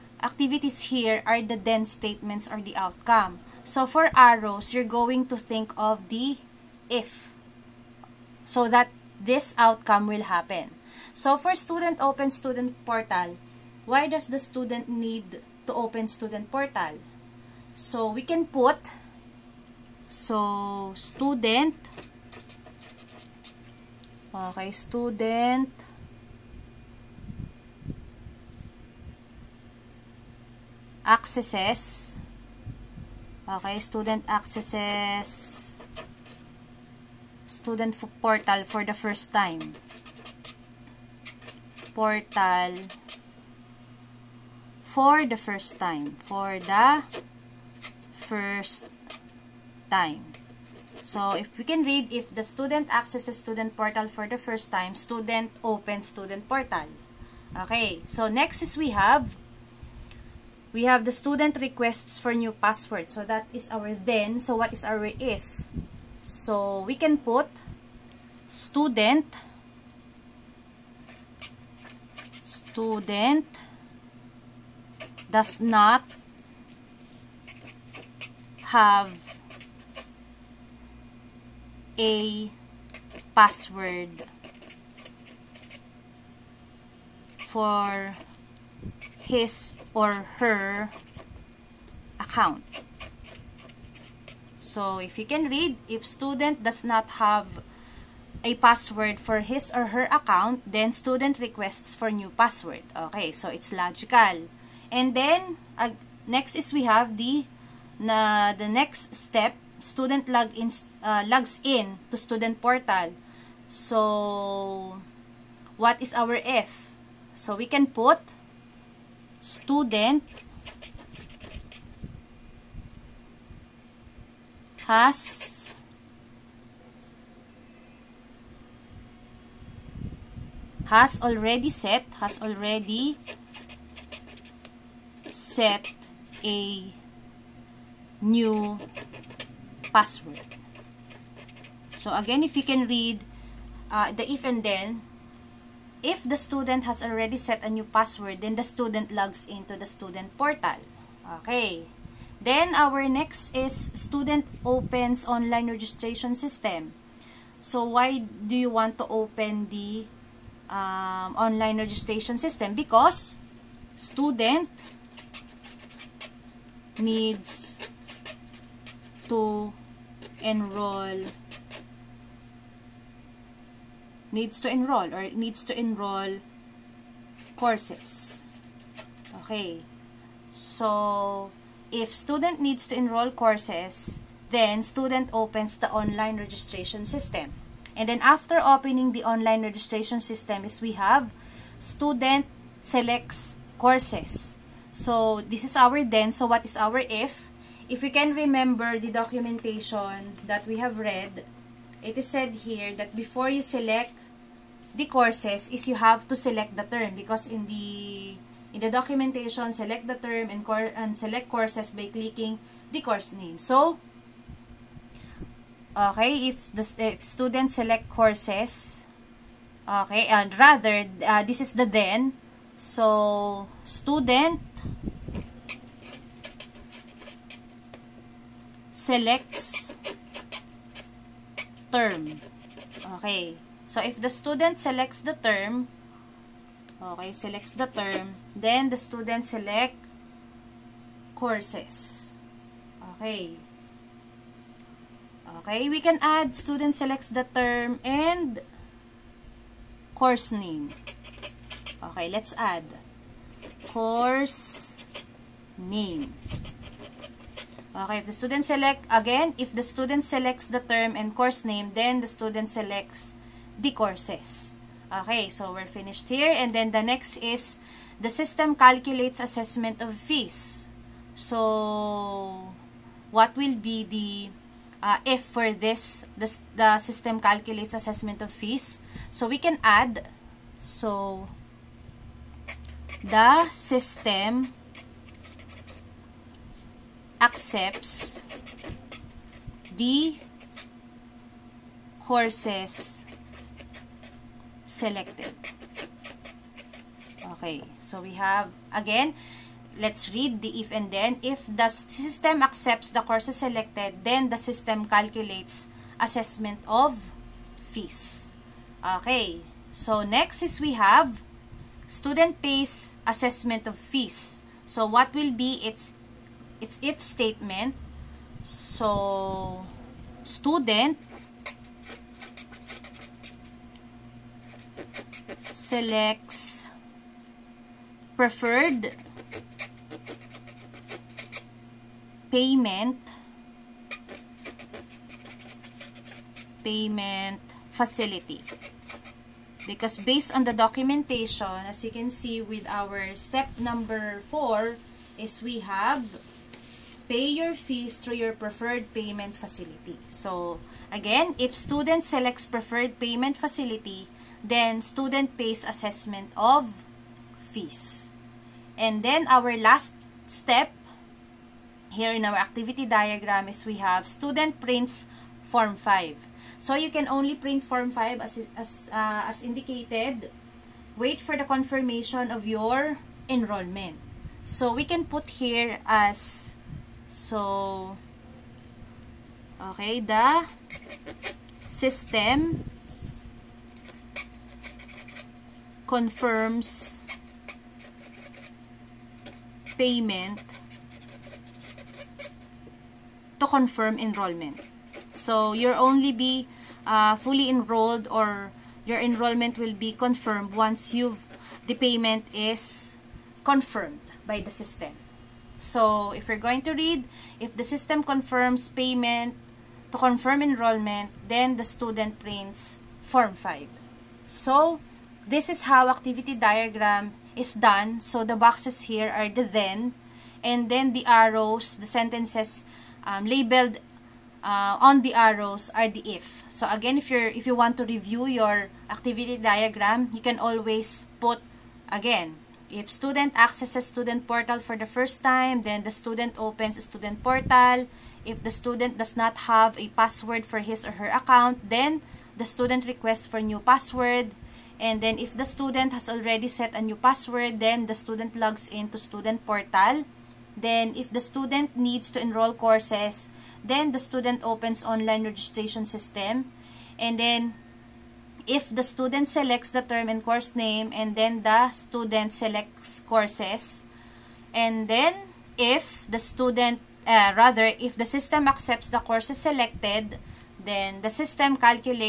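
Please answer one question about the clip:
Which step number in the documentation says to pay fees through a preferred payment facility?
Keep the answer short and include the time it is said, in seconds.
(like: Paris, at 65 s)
4, at 344 s.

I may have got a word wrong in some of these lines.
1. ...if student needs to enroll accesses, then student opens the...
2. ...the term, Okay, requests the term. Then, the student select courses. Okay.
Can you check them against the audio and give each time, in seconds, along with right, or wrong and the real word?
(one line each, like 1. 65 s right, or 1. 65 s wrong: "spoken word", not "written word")
1. 181 s wrong: "courses", not "accesses"
2. 235 s wrong: "selects", not "requests".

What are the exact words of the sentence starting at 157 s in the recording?
So, why do you want to open the um, online registration system?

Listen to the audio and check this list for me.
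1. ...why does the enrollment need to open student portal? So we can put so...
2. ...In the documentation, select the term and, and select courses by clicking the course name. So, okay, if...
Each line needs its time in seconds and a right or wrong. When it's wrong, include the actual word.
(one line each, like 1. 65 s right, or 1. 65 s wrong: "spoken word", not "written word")
1. 13 s wrong: "student", not "enrollment"
2. 208 s right.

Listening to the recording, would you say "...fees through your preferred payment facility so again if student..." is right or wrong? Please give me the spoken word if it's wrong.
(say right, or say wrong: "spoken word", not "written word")
right.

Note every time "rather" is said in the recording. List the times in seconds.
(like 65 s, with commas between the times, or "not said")
220 s, 467 s.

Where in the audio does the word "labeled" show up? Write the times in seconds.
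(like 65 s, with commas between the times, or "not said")
423 s.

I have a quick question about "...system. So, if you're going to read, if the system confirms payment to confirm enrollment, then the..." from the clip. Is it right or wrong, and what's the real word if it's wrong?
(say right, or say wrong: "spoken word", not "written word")
right.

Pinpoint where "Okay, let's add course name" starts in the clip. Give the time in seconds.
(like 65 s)
252 s.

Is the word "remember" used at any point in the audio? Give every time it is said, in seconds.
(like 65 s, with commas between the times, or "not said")
198 s.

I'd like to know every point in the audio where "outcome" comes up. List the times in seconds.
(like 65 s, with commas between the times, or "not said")
2 s, 9 s.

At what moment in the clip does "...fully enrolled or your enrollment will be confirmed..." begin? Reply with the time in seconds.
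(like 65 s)
397 s.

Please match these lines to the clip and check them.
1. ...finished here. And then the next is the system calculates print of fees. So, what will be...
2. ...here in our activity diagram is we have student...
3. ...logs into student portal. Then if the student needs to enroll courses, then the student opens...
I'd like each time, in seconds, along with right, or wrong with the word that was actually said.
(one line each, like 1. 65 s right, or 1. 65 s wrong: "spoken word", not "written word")
1. 265 s wrong: "assessment", not "print"
2. 362 s right
3. 448 s right.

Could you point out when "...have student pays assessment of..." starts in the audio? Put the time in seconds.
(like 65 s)
310 s.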